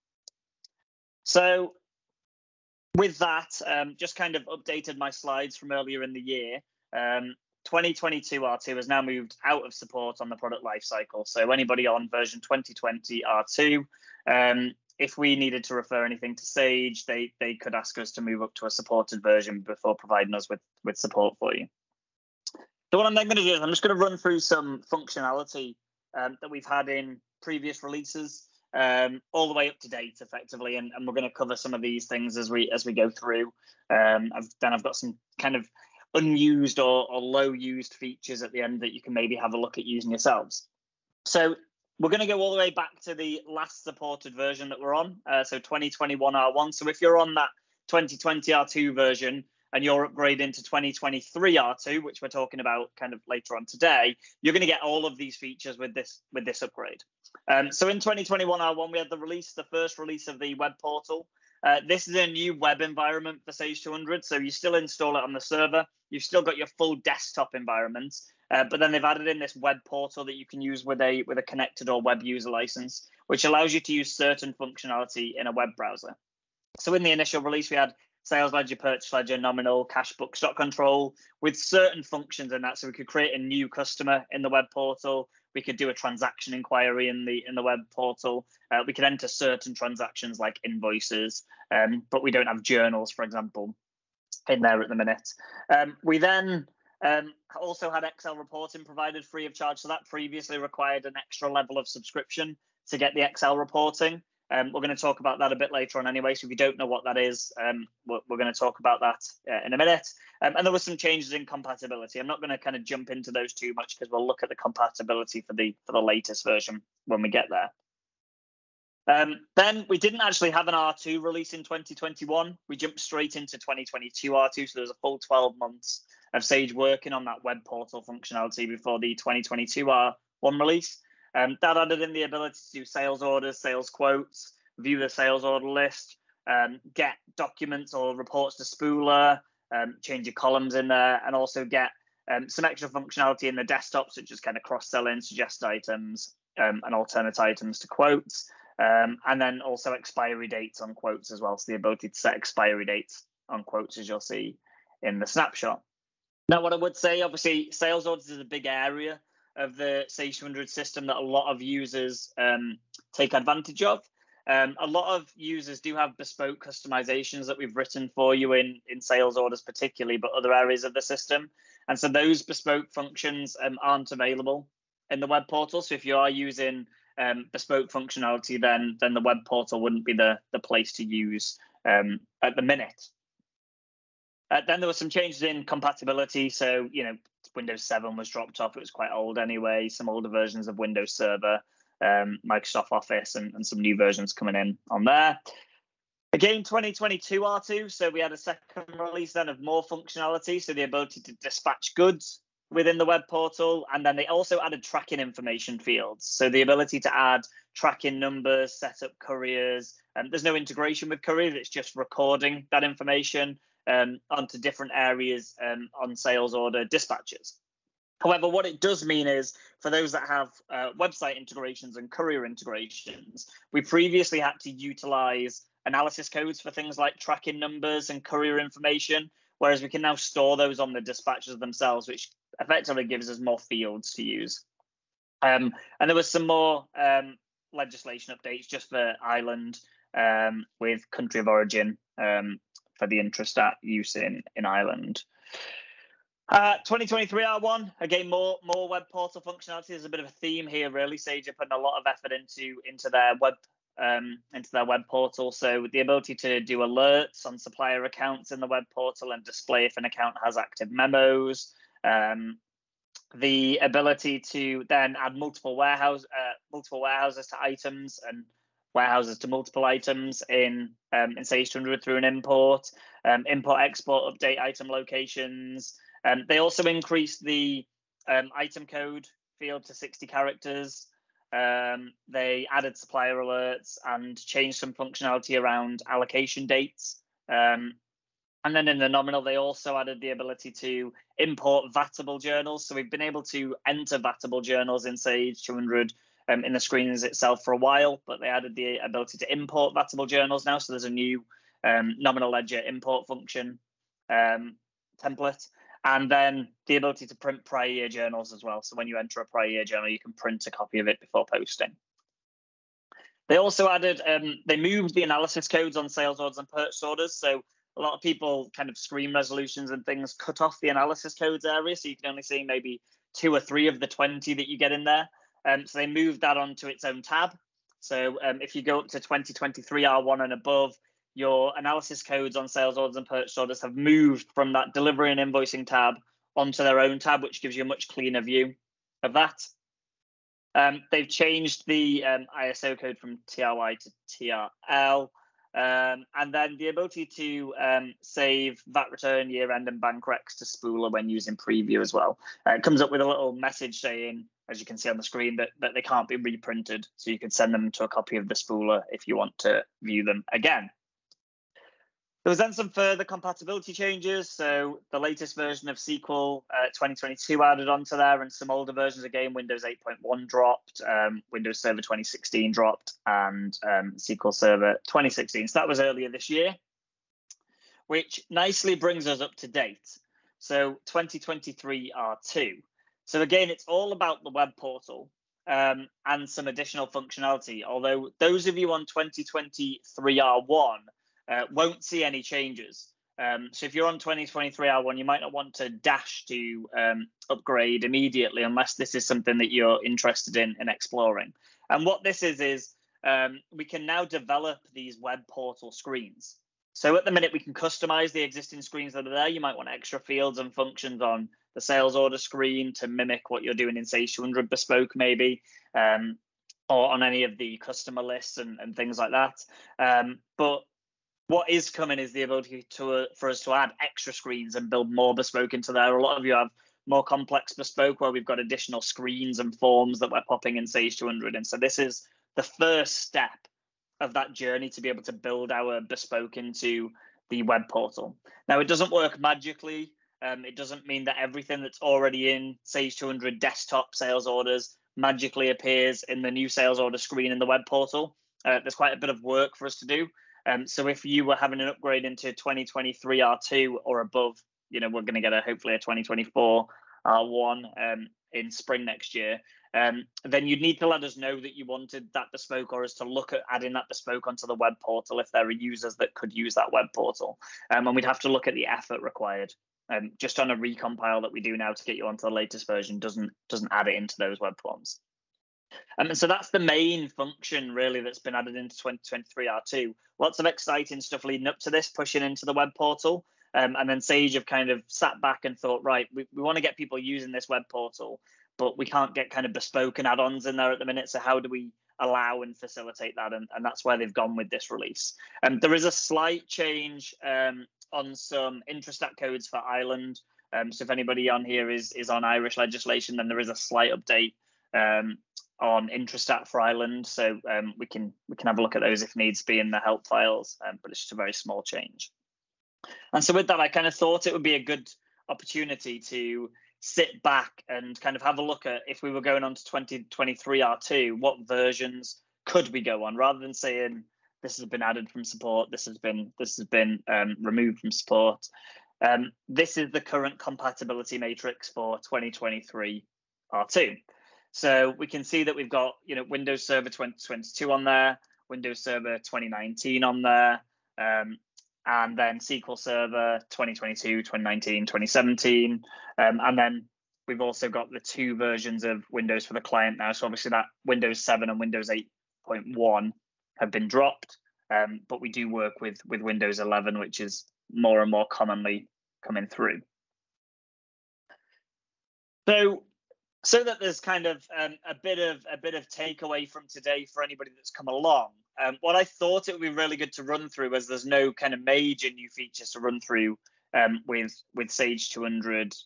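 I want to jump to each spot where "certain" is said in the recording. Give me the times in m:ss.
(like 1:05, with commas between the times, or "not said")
1:14, 1:21, 1:29.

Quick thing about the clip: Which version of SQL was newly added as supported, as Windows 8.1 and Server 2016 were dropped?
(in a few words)
SQL 2022.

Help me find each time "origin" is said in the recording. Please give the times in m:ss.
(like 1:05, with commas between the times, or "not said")
4:01.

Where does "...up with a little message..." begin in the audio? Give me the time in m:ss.
5:53.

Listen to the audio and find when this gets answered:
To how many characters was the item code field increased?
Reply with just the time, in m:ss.
4:39.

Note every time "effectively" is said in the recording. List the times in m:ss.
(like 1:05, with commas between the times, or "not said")
0:30, 3:52.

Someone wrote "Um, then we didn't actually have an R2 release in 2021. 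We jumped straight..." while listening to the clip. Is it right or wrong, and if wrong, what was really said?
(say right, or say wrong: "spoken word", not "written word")
right.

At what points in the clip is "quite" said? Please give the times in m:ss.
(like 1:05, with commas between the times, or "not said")
3:08, 7:28.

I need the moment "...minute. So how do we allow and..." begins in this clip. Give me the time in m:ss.
8:11.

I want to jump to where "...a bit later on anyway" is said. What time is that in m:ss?
1:45.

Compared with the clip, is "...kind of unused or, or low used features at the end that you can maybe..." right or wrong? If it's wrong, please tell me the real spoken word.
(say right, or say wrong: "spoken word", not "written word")
right.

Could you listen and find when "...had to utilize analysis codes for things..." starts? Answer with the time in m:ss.
3:44.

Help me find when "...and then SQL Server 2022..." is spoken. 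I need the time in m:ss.
9:02.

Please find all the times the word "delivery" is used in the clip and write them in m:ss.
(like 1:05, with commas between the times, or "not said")
5:34.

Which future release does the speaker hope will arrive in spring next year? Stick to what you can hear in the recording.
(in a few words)
2024 R1.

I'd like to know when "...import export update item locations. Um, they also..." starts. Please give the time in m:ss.
4:33.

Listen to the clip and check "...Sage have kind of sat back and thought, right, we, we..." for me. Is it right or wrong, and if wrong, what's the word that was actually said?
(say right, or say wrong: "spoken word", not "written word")
right.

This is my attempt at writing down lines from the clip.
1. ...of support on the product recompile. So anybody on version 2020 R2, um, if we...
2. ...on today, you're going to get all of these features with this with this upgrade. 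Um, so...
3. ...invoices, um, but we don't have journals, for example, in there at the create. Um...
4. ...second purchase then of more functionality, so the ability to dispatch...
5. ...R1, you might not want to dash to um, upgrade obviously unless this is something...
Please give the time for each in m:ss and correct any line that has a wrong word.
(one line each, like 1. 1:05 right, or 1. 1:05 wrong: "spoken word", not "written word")
1. 0:09 wrong: "lifecycle", not "recompile"
2. 0:53 right
3. 1:30 wrong: "minute", not "create"
4. 3:18 wrong: "release", not "purchase"
5. 6:34 wrong: "immediately", not "obviously".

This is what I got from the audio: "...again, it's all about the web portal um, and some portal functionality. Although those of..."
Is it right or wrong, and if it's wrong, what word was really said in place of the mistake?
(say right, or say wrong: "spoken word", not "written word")
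wrong: "additional", not "portal".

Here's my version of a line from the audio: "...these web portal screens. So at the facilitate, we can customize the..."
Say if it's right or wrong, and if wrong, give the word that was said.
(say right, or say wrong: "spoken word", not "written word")
wrong: "minute", not "facilitate".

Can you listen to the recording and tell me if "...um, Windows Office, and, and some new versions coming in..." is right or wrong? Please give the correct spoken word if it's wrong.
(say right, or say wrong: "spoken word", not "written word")
wrong: "Microsoft", not "Windows".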